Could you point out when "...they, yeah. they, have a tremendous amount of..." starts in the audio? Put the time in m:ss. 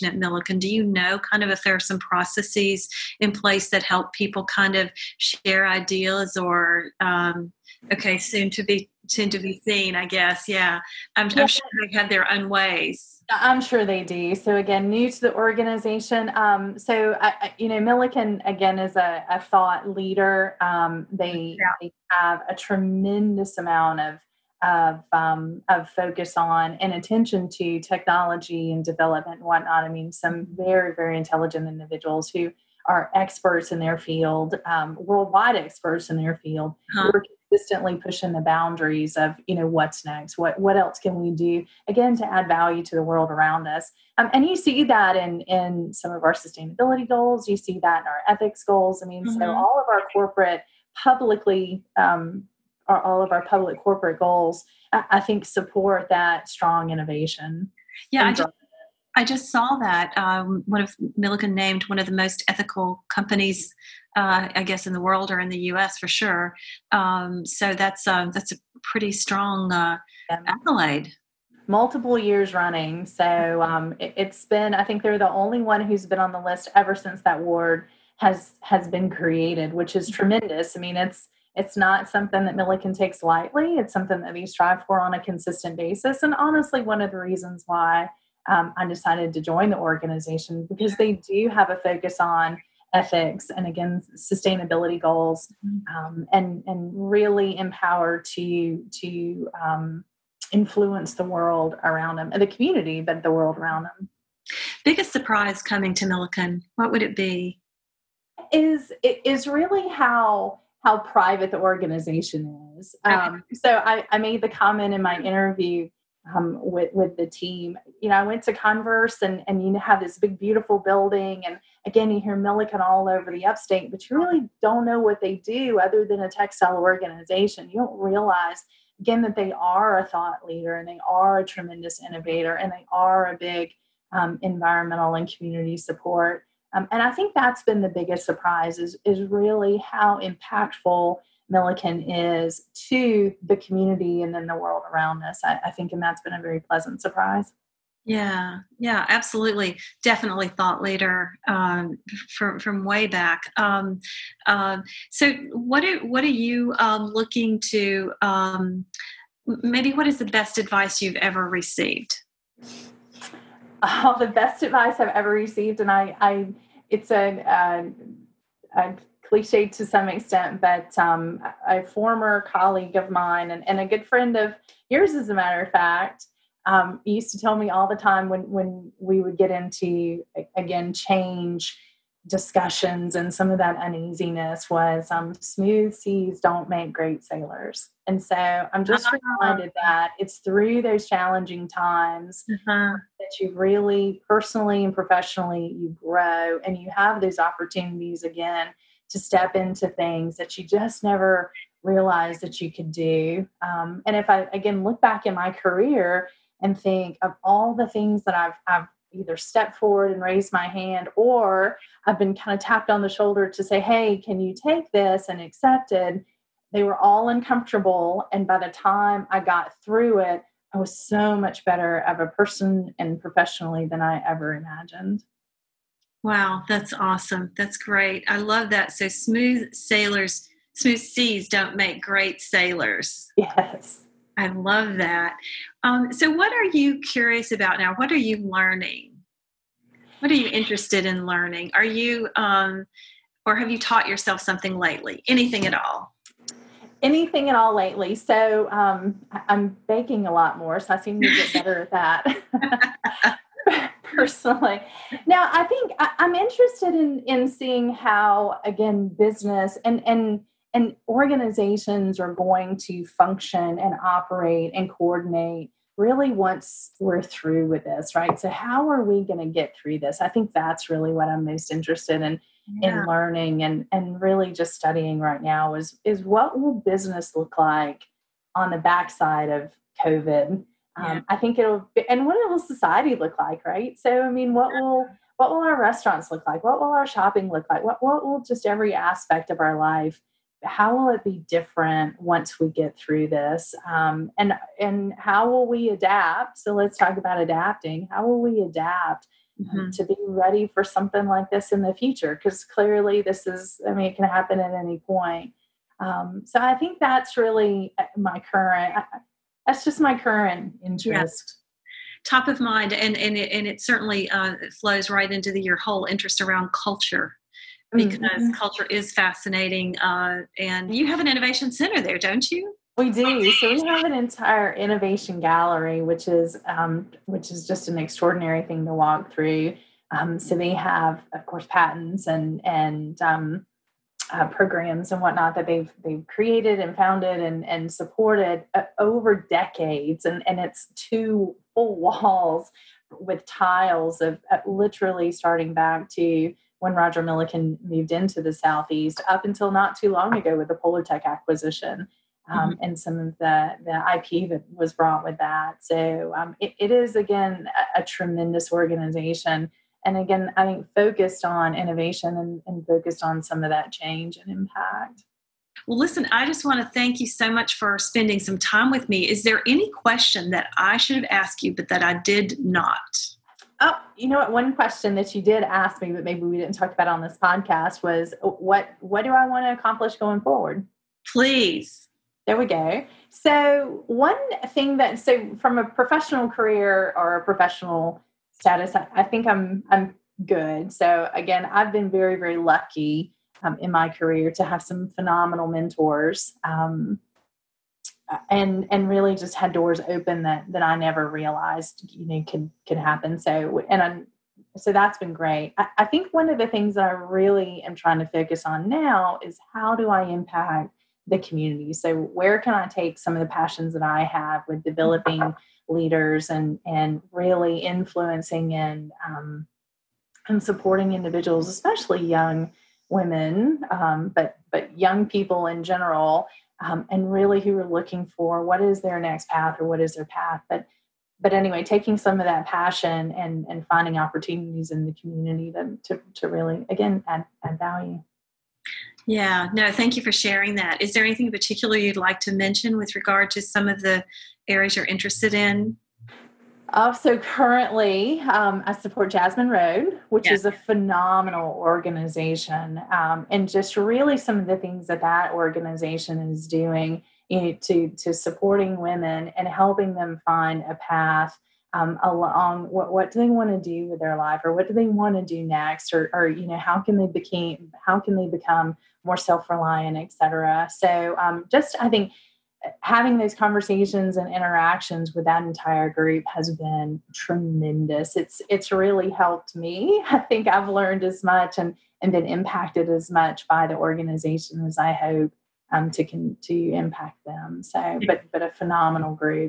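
0:21.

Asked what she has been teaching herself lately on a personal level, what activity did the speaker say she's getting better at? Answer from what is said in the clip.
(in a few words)
Baking.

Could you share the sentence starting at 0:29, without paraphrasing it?
I mean, some very very intelligent individuals who are experts in their field, um, worldwide experts in their field, huh.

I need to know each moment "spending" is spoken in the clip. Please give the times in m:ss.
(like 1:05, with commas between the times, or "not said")
6:07.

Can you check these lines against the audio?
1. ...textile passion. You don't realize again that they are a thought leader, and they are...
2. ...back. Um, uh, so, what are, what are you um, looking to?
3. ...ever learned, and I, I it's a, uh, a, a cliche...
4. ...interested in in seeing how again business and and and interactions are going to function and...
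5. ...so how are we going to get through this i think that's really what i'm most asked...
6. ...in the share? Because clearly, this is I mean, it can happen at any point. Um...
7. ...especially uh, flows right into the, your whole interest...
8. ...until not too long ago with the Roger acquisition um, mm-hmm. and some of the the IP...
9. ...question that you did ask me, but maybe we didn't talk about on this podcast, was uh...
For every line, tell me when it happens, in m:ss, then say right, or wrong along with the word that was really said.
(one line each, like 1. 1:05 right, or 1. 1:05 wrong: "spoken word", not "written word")
1. 2:06 wrong: "organization", not "passion"
2. 2:33 right
3. 2:45 wrong: "received", not "learned"
4. 4:16 wrong: "organizations", not "interactions"
5. 4:28 wrong: "interested", not "asked"
6. 5:01 wrong: "future", not "share"
7. 5:13 wrong: "certainly", not "especially"
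8. 5:49 wrong: "Polartec", not "Roger"
9. 6:14 right.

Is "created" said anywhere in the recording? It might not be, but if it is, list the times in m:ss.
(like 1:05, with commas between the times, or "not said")
1:19, 5:36.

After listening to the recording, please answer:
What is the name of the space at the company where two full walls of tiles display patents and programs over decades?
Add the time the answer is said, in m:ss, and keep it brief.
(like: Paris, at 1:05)
Innovation gallery, at 5:24.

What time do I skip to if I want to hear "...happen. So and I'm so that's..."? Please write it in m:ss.
6:42.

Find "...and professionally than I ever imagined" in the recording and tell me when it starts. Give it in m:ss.
3:42.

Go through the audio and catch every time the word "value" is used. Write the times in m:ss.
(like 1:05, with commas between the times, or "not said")
0:42, 7:17.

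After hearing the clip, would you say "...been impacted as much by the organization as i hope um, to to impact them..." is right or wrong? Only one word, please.
right.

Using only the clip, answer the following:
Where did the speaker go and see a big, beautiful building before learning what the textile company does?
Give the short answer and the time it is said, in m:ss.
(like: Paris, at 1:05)
Converse, at 1:58.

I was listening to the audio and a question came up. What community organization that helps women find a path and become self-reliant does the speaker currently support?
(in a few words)
Jasmine Road.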